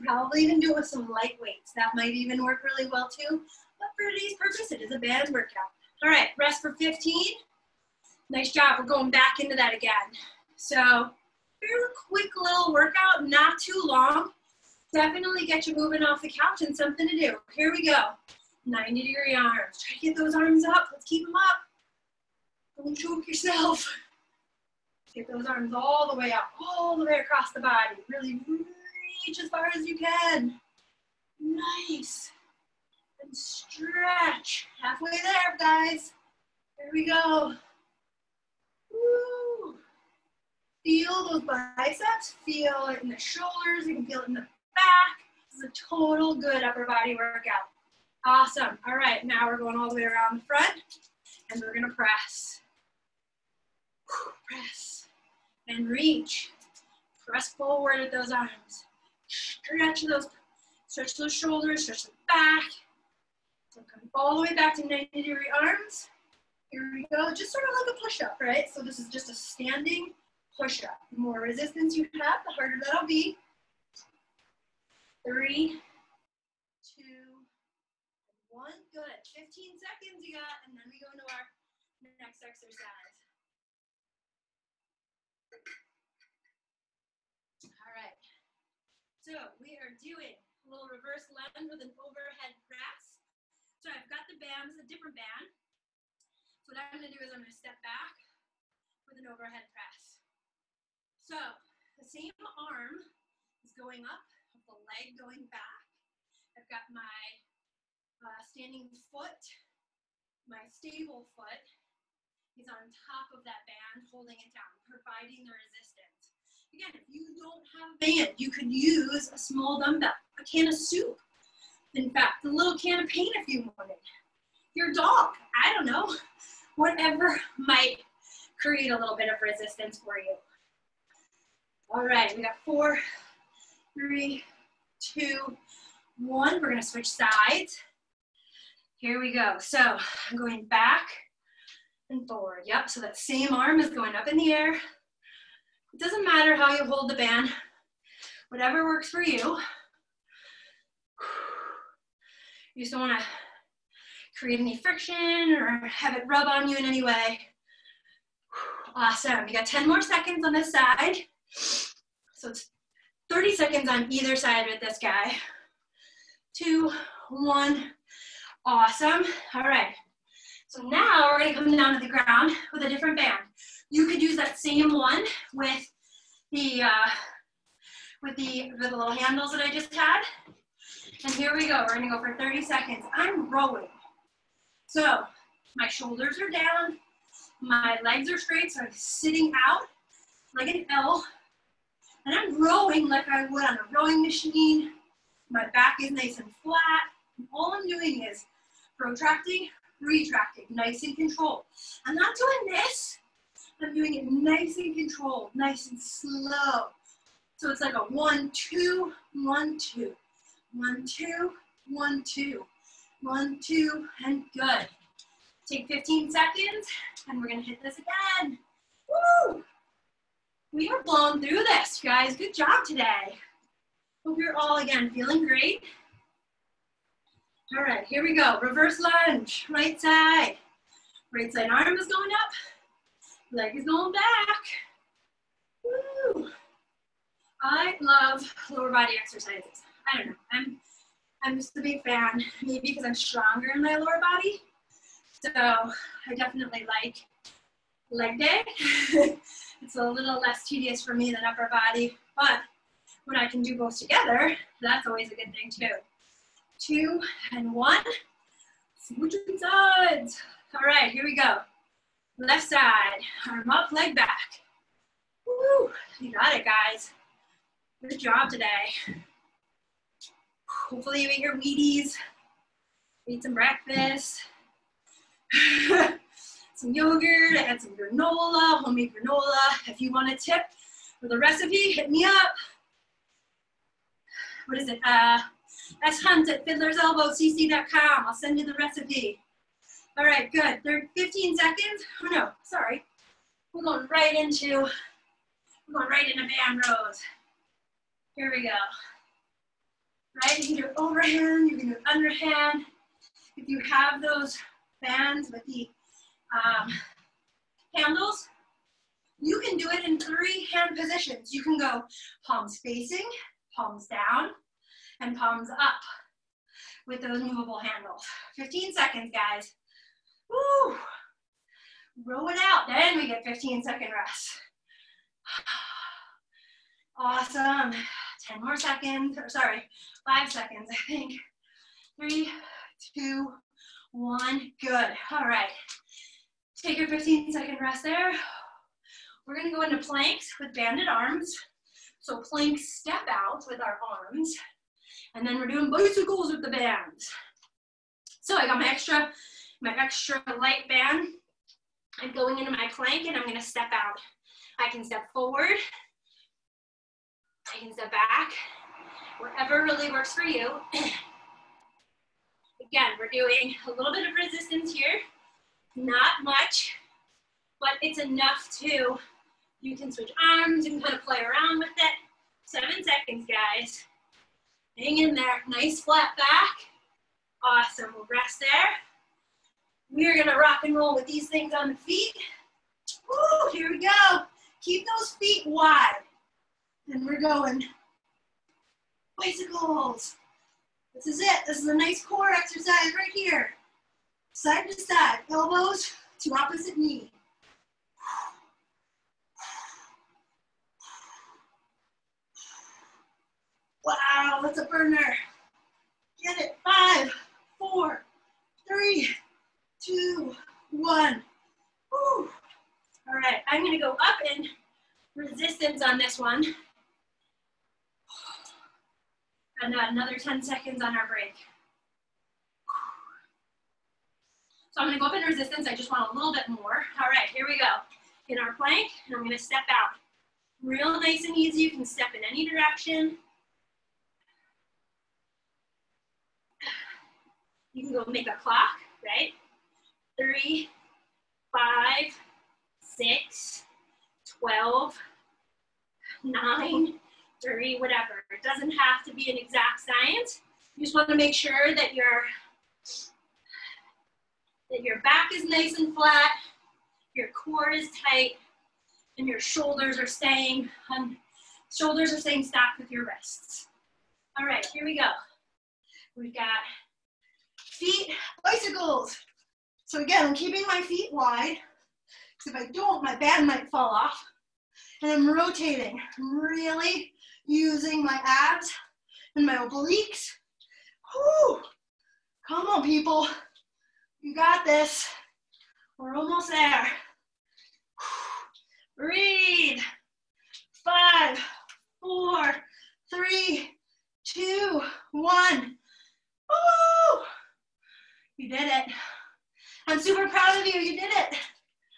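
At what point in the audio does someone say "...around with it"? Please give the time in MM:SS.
06:11.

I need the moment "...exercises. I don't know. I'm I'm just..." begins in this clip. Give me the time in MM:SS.
03:59.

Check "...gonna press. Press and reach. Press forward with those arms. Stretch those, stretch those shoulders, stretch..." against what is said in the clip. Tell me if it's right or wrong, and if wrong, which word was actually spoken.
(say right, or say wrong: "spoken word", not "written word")
right.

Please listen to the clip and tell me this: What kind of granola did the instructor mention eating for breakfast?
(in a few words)
homemade granola.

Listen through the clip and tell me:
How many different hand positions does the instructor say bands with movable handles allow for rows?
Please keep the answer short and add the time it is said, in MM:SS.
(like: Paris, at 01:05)
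3, at 05:10.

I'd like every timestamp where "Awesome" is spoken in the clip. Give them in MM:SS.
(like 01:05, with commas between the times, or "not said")
00:48, 02:38, 02:48, 05:27, 06:17.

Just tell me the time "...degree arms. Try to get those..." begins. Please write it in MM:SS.
00:19.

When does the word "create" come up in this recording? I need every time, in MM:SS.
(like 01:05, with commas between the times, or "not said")
02:08, 02:34.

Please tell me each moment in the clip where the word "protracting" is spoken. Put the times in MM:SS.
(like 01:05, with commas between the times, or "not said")
03:18.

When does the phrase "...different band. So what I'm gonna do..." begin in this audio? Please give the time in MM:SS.
01:34.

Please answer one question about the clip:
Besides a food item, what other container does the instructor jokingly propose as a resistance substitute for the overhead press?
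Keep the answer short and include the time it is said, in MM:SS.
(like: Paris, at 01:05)
a little can of paint, at 02:02.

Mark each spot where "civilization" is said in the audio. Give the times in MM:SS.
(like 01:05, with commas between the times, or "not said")
not said.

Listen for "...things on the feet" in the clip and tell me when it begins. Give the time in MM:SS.
06:21.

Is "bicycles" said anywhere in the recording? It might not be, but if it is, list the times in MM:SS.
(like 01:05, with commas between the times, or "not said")
05:45, 06:29, 07:48.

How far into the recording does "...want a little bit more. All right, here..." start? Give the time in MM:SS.
07:06.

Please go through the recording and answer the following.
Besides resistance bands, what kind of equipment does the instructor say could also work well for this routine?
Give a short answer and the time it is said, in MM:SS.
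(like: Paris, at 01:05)
light weights, at 00:01.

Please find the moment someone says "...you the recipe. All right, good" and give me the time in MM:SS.
04:48.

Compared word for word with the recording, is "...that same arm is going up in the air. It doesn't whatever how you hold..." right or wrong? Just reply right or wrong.
wrong.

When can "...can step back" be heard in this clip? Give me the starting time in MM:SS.
05:57.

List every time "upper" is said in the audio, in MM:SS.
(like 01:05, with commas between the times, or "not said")
00:46, 04:11.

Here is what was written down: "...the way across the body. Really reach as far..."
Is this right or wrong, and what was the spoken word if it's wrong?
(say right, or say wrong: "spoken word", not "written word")
right.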